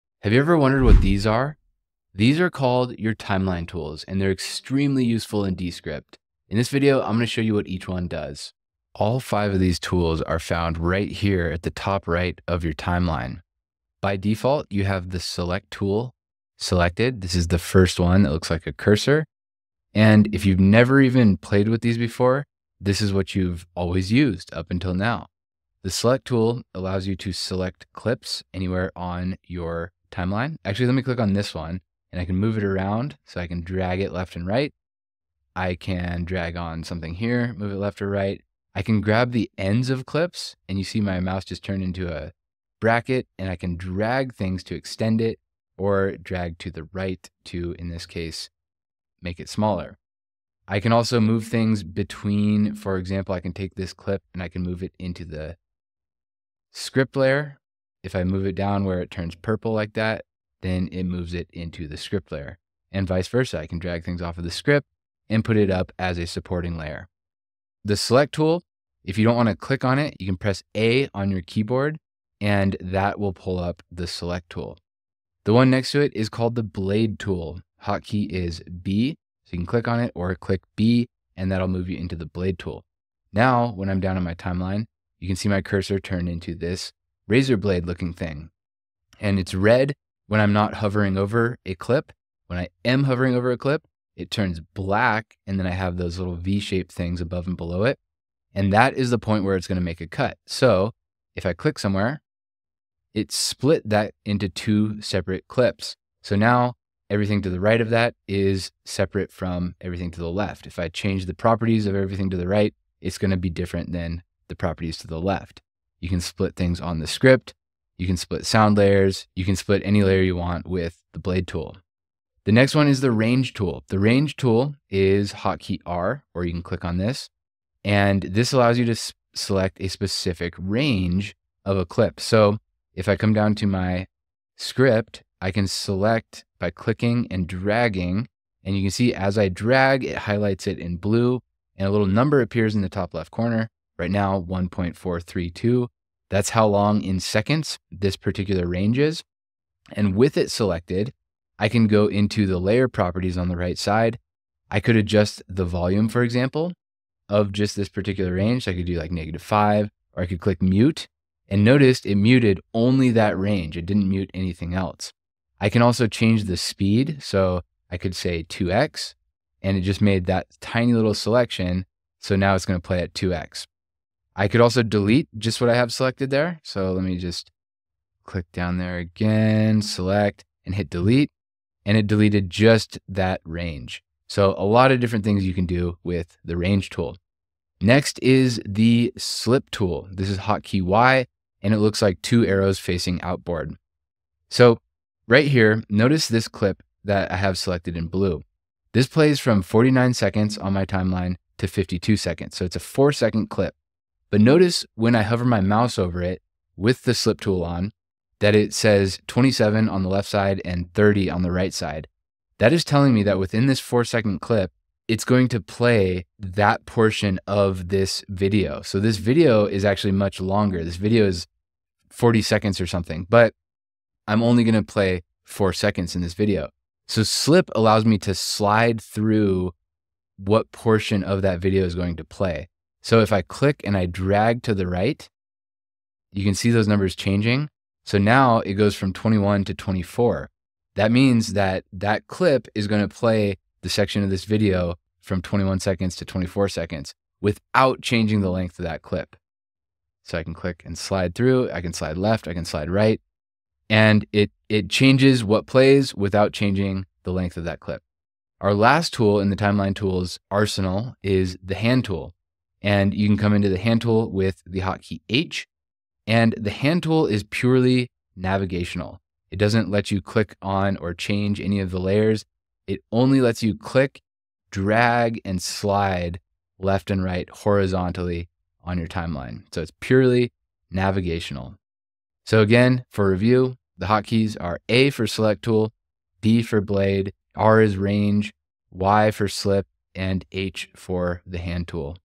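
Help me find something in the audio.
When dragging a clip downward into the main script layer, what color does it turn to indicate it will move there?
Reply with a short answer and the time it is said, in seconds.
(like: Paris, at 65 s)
Purple, at 59 s.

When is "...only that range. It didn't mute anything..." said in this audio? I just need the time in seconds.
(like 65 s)
162 s.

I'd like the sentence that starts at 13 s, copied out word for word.
By default, you have the select tool selected.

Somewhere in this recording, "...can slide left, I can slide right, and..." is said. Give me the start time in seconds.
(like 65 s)
251 s.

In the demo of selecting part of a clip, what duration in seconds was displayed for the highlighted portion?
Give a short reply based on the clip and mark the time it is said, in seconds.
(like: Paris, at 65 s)
1.432, at 144 s.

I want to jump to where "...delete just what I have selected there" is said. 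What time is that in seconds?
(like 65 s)
174 s.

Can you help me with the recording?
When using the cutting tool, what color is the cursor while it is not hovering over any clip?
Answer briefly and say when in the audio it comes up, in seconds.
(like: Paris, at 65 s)
Red, at 89 s.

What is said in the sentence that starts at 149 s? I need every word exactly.
And with it selected, I can go into the layer properties on the right side.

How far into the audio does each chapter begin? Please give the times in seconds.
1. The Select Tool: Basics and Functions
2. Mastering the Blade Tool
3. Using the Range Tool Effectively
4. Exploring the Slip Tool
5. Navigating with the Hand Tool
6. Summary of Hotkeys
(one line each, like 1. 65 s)
1. 13 s
2. 75 s
3. 122 s
4. 187 s
5. 258 s
6. 282 s.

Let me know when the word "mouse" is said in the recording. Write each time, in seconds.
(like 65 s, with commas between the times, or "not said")
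41 s, 205 s.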